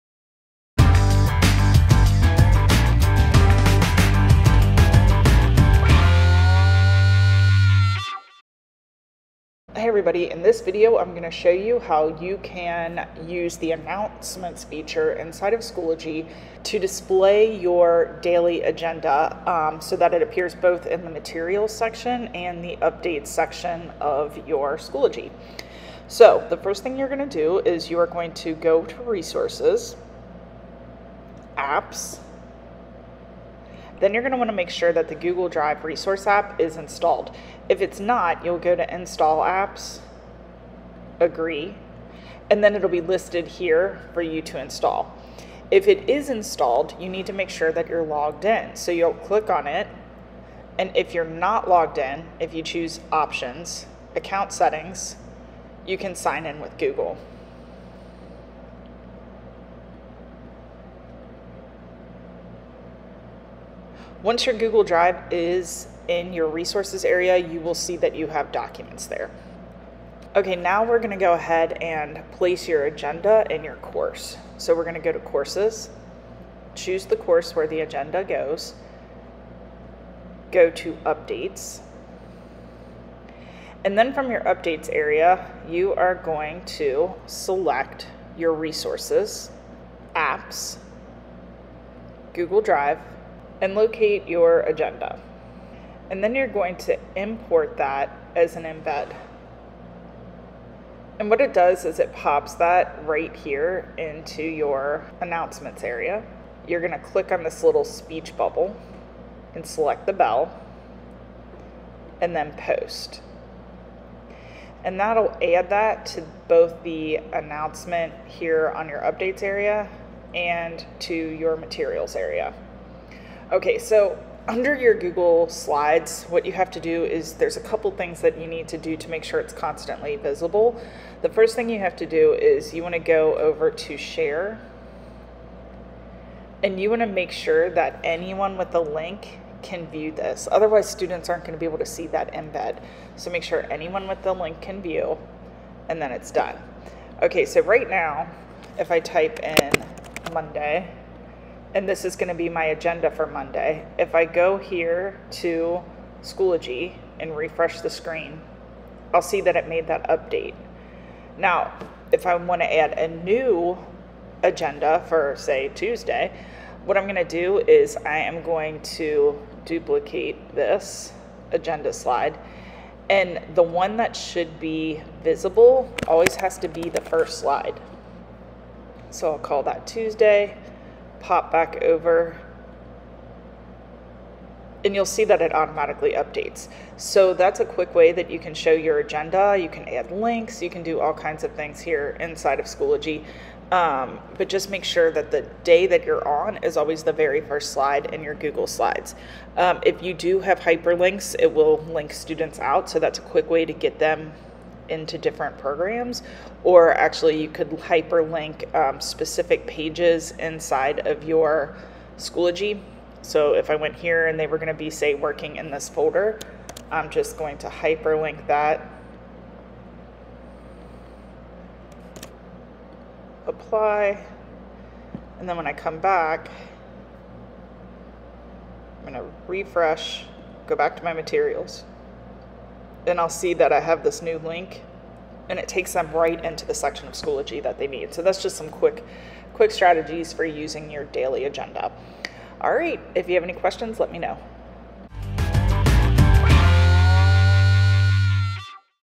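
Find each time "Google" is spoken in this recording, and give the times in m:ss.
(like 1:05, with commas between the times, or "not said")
0:35, 0:56, 1:04, 1:32, 2:04, 3:18.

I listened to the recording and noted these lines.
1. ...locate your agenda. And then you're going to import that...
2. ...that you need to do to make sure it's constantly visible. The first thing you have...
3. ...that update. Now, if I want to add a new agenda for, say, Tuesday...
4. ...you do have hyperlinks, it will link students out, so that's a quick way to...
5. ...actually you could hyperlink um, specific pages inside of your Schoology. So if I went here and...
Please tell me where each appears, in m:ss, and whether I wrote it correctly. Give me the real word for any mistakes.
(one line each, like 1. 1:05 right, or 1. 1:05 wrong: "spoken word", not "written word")
1. 1:33 right
2. 2:08 right
3. 2:39 right
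4. 3:20 right
5. 3:26 right.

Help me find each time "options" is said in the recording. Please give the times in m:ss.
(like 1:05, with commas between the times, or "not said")
0:53.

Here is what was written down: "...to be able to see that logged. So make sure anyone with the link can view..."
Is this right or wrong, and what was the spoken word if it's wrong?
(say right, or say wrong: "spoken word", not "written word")
wrong: "embed", not "logged".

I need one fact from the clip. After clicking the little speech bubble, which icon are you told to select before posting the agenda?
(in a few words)
the bell.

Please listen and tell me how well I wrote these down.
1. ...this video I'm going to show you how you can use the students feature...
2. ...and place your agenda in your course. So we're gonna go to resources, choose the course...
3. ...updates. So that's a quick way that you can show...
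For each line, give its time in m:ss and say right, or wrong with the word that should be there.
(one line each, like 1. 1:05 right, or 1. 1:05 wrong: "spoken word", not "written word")
1. 0:10 wrong: "announcements", not "students"
2. 1:11 wrong: "courses", not "resources"
3. 3:06 right.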